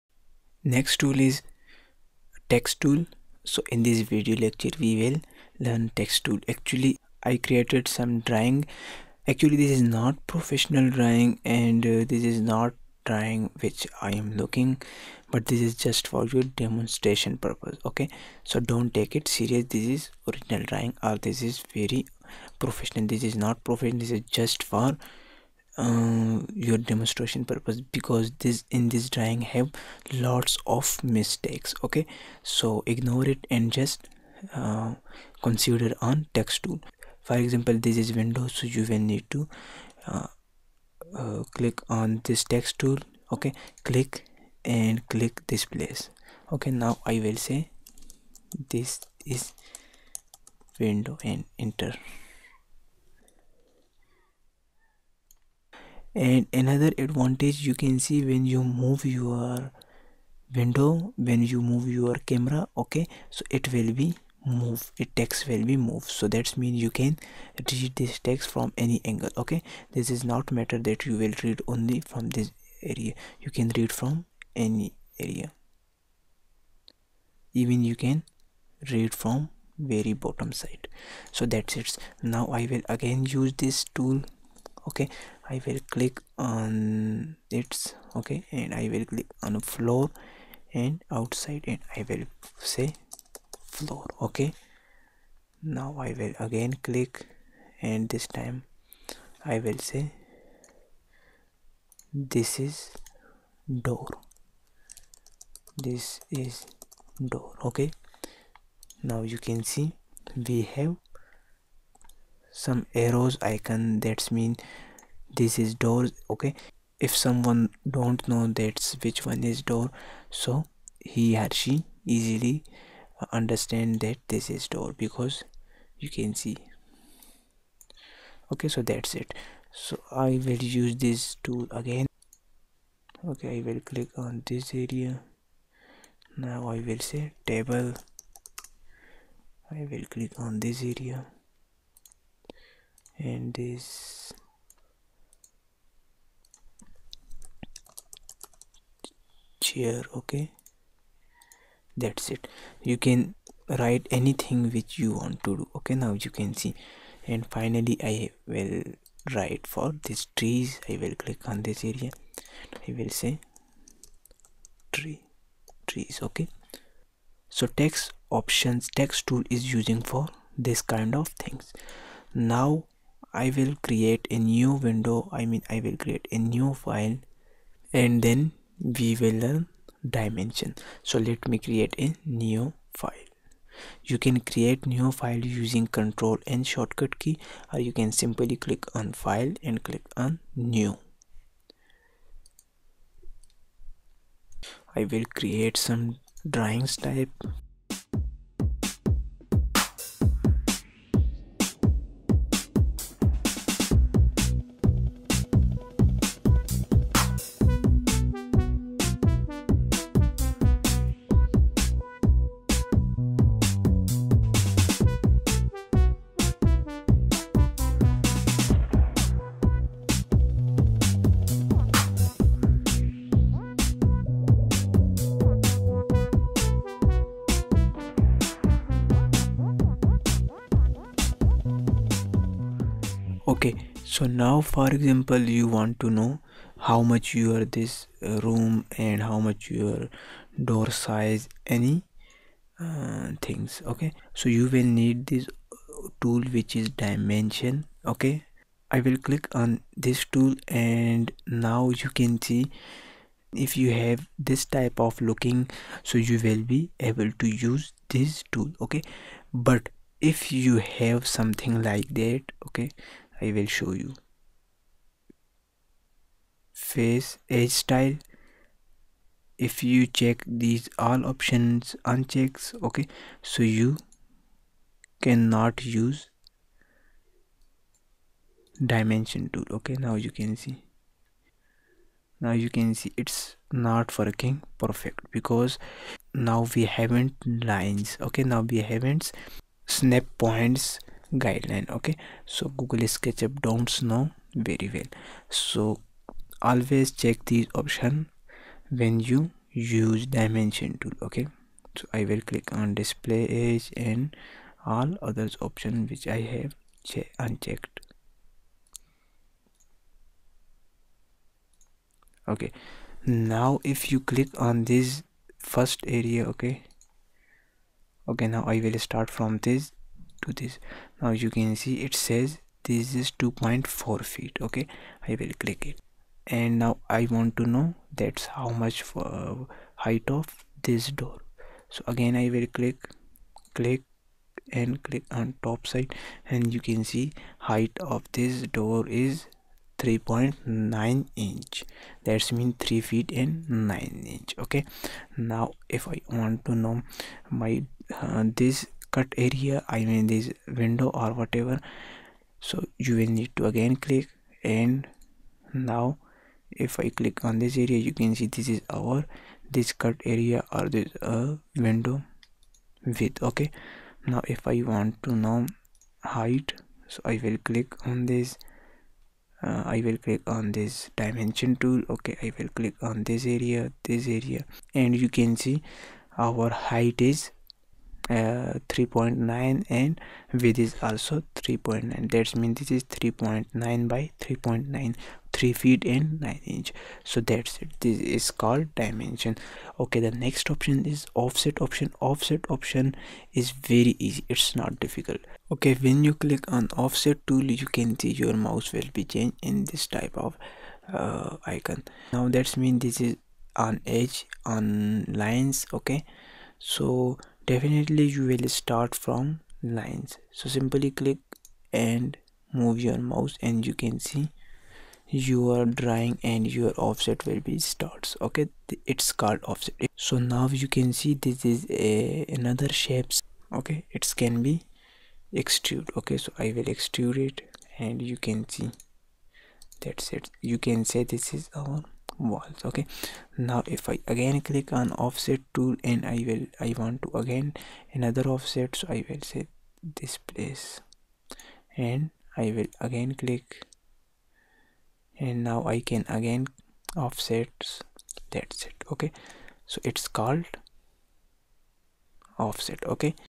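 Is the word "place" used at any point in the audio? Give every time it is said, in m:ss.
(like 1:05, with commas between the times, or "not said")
0:45, 7:20.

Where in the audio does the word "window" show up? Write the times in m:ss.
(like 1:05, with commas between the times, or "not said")
0:38, 0:50, 1:00, 2:54, 5:50, 6:01.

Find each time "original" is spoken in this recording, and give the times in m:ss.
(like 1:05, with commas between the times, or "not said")
0:20.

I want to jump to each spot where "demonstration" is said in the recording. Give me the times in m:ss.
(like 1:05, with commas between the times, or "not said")
0:16, 0:26.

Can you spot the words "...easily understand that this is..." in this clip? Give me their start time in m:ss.
2:02.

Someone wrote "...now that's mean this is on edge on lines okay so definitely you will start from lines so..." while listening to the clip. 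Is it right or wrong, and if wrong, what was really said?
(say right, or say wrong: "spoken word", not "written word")
right.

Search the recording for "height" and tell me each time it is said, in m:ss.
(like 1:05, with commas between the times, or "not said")
5:30, 5:37, 6:06, 6:16.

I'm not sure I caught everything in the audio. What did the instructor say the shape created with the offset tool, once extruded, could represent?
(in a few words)
walls.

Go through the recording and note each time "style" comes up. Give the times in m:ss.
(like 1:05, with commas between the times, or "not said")
4:27.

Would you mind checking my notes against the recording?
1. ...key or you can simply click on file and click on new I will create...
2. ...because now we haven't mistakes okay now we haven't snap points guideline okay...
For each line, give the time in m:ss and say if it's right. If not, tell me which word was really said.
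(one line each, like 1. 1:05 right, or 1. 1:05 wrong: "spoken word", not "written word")
1. 3:07 right
2. 4:45 wrong: "lines", not "mistakes".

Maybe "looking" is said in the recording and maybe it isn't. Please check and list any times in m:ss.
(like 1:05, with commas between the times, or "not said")
0:14, 4:15.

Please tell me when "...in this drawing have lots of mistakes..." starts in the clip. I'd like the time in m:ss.
0:28.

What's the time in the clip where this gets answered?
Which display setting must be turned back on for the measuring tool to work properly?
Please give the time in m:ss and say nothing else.
5:02.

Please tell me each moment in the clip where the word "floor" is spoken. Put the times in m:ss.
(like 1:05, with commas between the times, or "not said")
1:29, 1:33.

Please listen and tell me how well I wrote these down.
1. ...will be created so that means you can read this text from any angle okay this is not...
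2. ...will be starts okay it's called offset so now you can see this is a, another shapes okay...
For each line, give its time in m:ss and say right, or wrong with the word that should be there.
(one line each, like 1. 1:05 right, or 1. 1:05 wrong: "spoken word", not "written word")
1. 1:05 wrong: "moved", not "created"
2. 6:57 right.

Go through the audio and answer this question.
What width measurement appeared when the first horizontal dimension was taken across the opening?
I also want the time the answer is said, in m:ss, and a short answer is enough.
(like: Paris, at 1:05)
2.4 feet, at 5:23.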